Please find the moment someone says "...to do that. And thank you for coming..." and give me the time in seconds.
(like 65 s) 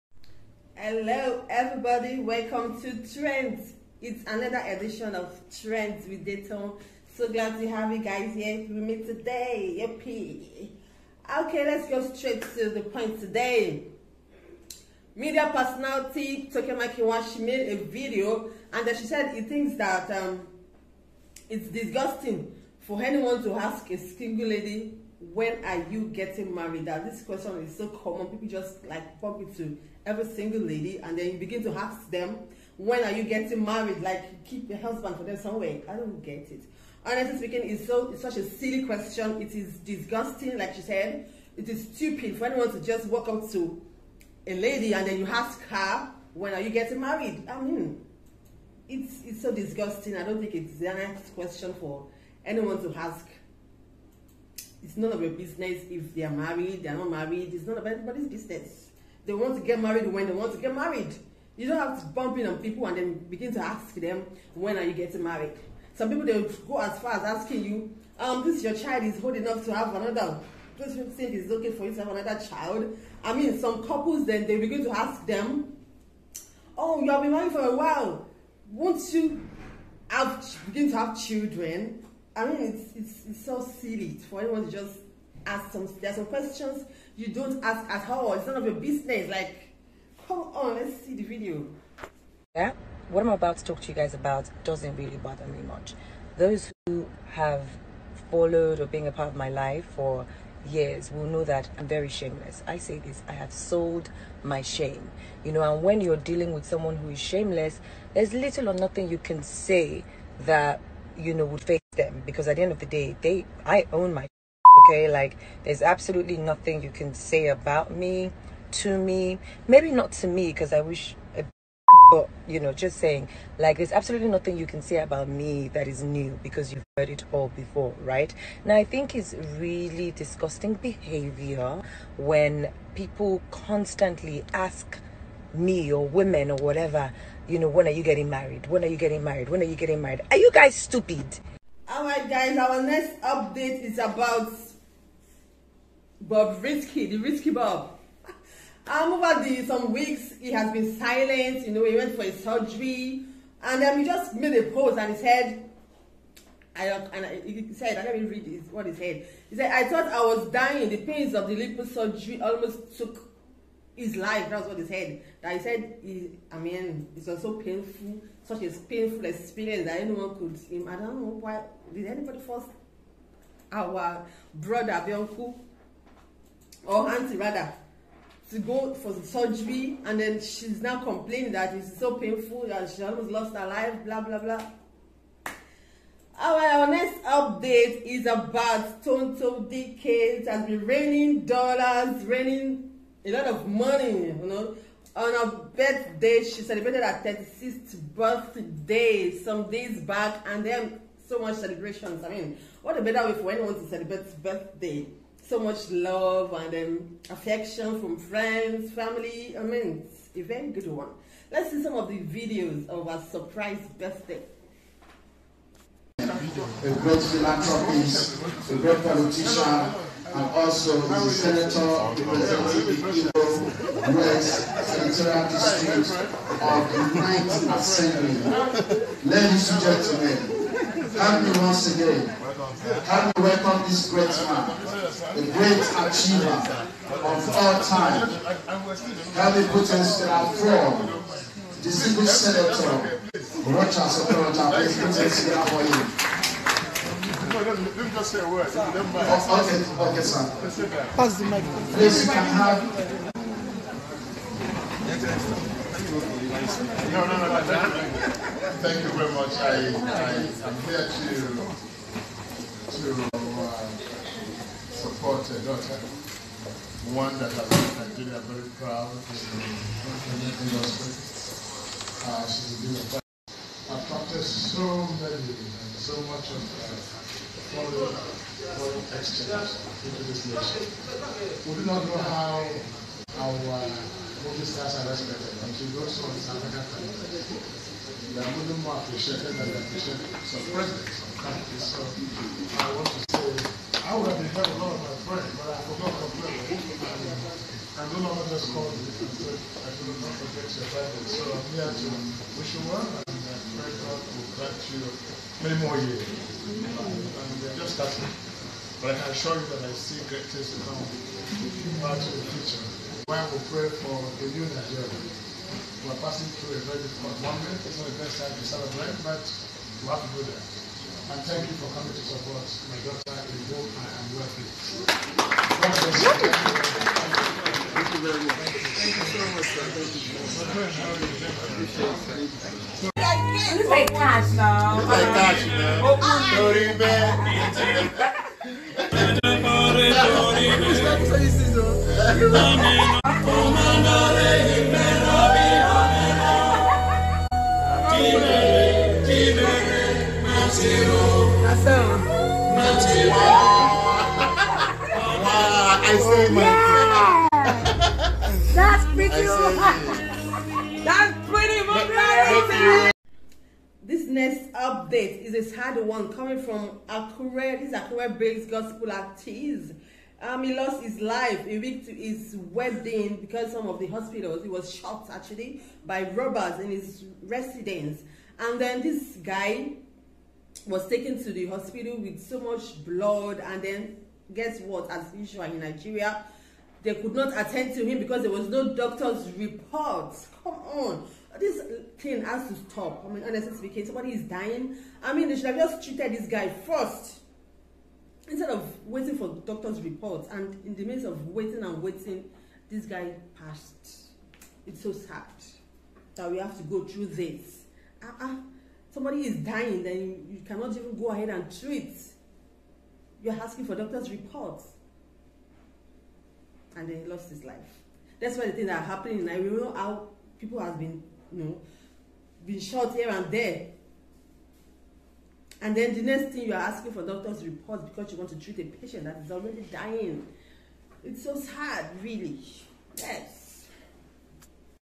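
320 s.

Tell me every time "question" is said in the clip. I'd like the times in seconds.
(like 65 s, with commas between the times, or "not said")
27 s, 38 s, 51 s, 86 s.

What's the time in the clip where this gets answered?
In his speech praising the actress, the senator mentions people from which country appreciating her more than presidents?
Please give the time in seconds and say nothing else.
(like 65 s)
286 s.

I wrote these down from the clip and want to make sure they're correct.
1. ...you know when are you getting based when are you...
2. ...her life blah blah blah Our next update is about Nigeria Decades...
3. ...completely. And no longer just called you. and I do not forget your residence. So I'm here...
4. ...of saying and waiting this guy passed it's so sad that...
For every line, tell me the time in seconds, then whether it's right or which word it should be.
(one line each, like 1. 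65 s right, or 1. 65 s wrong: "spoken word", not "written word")
1. 137 s wrong: "married", not "based"
2. 183 s wrong: "Tonto", not "Nigeria"
3. 296 s wrong: "presence", not "residence"
4. 401 s wrong: "waiting", not "saying".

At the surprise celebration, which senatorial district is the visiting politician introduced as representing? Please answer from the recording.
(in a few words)
Imo West.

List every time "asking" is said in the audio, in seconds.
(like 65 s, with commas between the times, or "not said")
67 s, 413 s, 426 s.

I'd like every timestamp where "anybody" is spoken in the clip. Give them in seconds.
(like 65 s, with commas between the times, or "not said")
57 s, 172 s.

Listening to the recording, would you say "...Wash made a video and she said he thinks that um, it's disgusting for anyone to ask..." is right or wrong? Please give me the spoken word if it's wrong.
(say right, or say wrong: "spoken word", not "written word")
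right.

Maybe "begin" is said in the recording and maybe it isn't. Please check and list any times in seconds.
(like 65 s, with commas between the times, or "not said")
31 s, 63 s, 74 s, 80 s.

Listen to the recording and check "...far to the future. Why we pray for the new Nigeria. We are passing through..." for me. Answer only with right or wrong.
right.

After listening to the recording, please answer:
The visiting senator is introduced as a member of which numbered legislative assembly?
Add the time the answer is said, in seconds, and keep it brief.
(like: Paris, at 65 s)
Ninth Assembly, at 227 s.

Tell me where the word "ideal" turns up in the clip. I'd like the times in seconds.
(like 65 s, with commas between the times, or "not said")
not said.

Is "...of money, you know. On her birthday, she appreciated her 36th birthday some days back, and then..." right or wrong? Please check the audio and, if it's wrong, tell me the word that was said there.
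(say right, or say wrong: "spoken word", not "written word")
wrong: "celebrated", not "appreciated".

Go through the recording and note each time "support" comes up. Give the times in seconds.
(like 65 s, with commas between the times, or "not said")
264 s, 322 s.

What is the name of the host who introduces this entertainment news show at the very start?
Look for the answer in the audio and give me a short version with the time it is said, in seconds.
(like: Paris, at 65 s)
Dayton, at 6 s.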